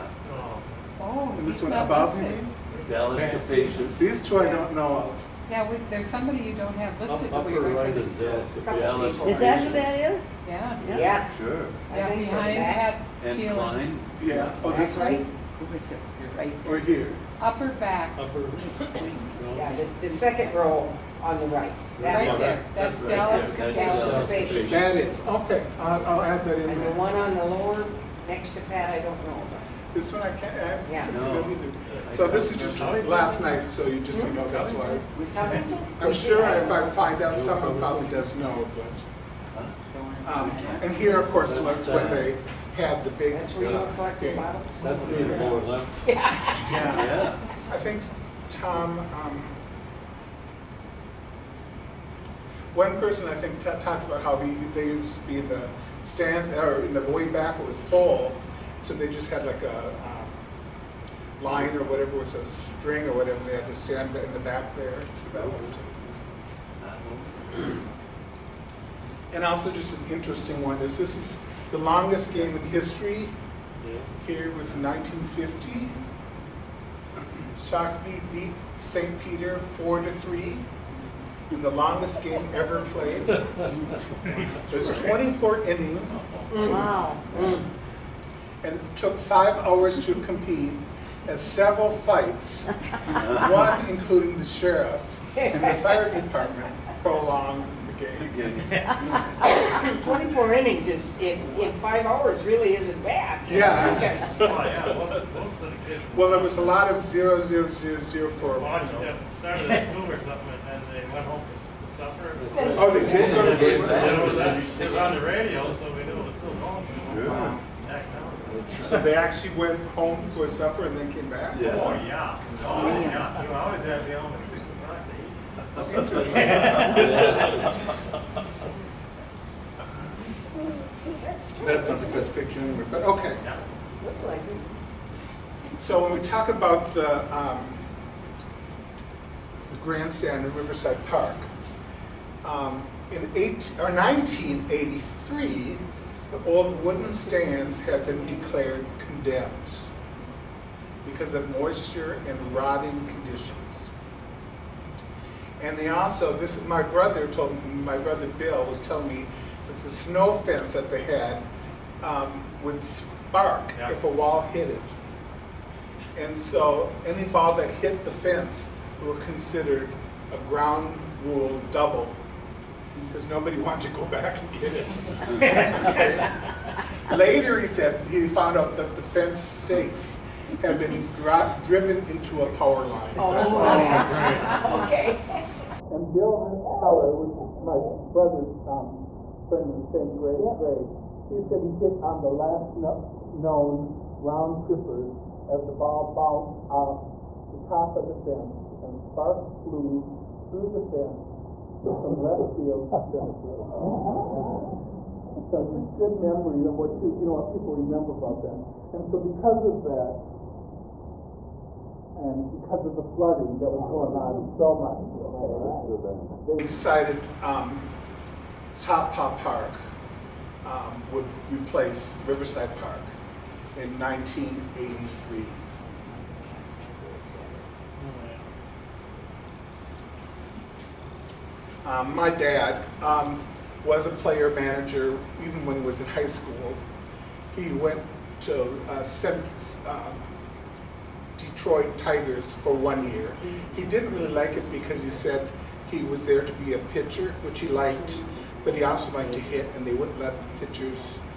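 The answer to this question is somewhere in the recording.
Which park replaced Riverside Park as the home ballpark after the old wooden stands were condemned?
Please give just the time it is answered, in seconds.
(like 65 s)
218 s.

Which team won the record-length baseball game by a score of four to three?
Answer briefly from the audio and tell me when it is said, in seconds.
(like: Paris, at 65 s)
Shock, at 77 s.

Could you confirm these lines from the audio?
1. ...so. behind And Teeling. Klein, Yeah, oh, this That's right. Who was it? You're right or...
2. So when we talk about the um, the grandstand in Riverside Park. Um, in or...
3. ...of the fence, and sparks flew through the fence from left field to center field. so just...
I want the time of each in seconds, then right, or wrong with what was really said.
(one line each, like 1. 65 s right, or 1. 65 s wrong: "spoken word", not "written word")
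1. 12 s right
2. 135 s right
3. 197 s right.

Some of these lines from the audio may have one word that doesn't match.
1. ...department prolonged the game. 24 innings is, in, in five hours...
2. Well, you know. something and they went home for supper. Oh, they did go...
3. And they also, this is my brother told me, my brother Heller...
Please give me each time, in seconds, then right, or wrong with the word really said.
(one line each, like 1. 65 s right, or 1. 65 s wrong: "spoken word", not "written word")
1. 96 s right
2. 108 s right
3. 155 s wrong: "Bill", not "Heller".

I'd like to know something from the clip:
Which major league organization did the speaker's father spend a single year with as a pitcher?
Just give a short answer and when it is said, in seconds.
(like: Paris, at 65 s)
Detroit Tigers, at 241 s.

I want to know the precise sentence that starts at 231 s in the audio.
Um, my dad um, was a player manager even when he was in high school.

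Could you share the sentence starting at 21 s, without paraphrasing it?
Right there, that's Dallas, That's Dallas Dallas Station.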